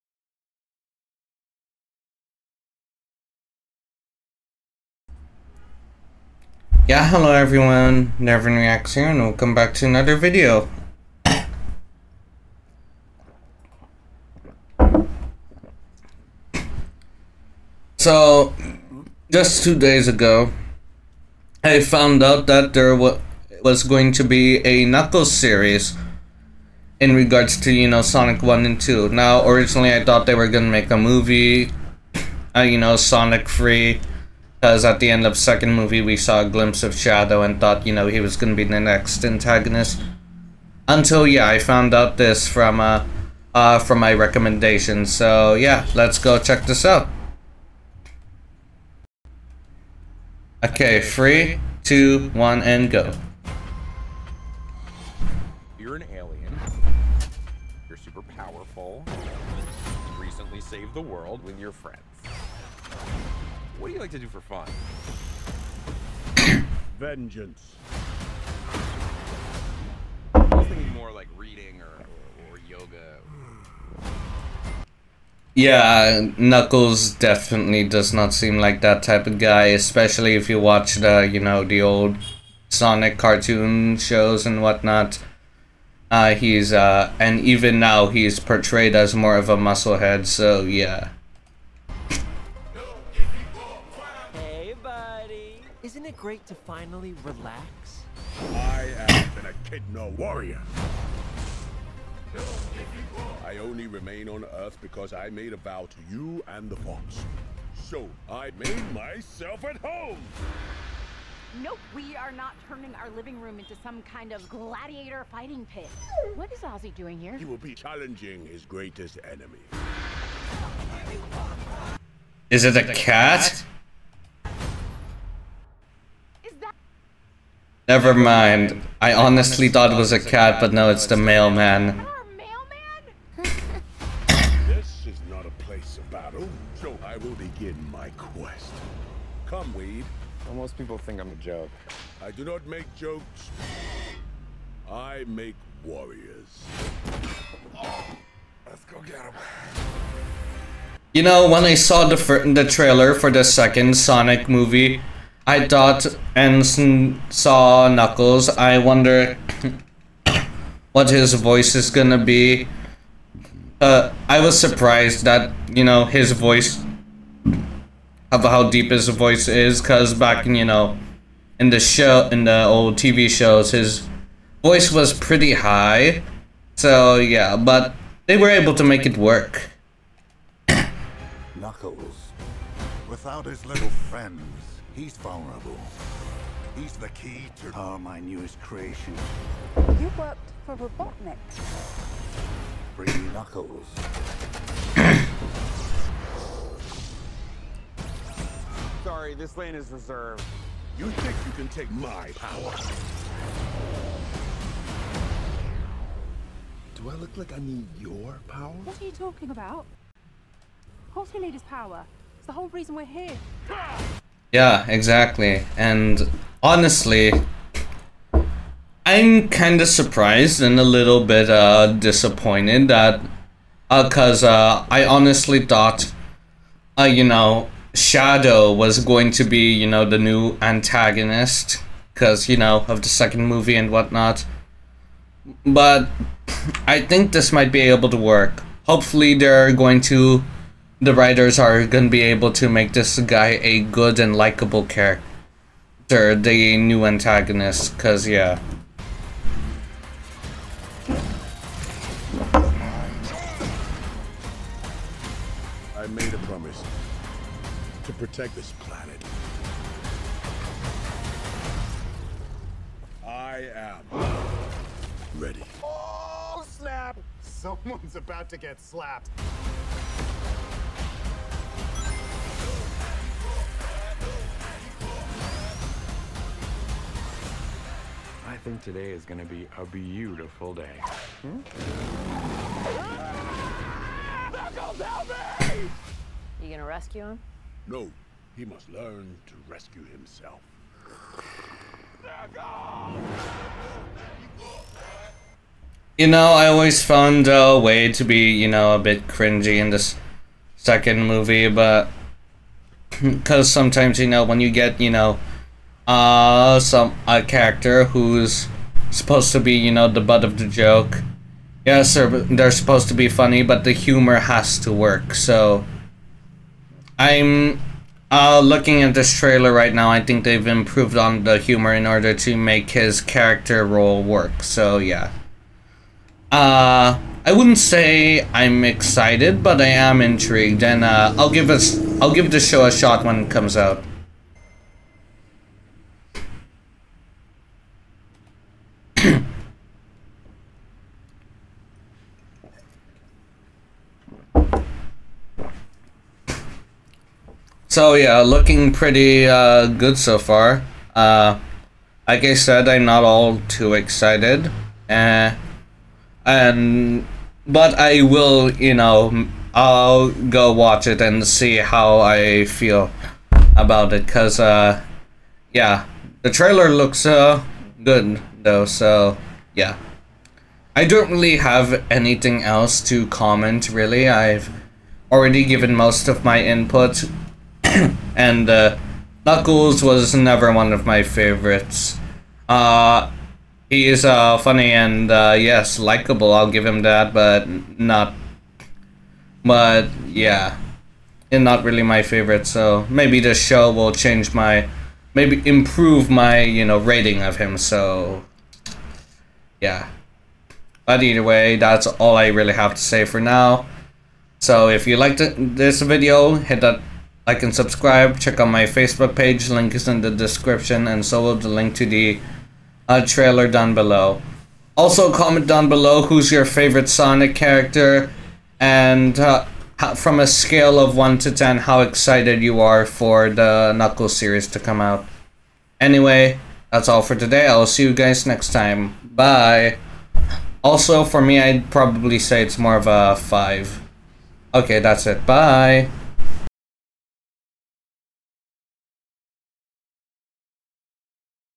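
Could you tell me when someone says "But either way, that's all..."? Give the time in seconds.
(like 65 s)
401 s.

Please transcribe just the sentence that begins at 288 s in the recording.
He must learn to rescue himself.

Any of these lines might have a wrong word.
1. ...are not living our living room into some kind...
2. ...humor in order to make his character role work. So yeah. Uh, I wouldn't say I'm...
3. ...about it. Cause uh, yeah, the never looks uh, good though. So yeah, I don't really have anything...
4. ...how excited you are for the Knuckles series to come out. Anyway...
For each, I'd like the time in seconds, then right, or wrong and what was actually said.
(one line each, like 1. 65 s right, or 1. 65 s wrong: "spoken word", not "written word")
1. 112 s wrong: "turning", not "living"
2. 321 s right
3. 363 s wrong: "trailer", not "never"
4. 421 s right.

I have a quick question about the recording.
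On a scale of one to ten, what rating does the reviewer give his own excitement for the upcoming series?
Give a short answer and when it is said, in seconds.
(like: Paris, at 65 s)
5, at 433 s.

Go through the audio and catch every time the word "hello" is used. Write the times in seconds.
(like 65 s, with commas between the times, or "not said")
7 s.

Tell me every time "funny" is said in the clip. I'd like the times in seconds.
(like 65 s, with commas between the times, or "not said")
313 s, 384 s.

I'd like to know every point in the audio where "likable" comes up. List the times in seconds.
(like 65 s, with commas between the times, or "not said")
244 s, 385 s.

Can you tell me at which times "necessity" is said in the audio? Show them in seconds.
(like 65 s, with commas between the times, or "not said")
not said.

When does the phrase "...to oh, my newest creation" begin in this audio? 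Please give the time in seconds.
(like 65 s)
187 s.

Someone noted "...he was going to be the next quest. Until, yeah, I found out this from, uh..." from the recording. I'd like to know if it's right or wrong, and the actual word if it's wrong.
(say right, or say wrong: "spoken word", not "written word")
wrong: "antagonist", not "quest".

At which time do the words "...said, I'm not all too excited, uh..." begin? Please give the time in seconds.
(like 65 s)
352 s.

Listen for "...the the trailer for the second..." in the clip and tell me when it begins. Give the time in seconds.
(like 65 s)
152 s.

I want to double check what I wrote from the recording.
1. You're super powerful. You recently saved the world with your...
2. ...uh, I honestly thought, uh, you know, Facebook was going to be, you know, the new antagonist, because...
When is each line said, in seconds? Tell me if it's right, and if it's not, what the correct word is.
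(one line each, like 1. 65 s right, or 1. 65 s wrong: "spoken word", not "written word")
1. 57 s right
2. 224 s wrong: "Shadow", not "Facebook".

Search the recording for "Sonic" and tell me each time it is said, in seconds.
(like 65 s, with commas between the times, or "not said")
28 s, 32 s, 82 s, 153 s, 417 s.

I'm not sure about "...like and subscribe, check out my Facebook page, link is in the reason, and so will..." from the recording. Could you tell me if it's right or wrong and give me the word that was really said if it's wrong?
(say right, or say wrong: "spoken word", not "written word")
wrong: "description", not "reason".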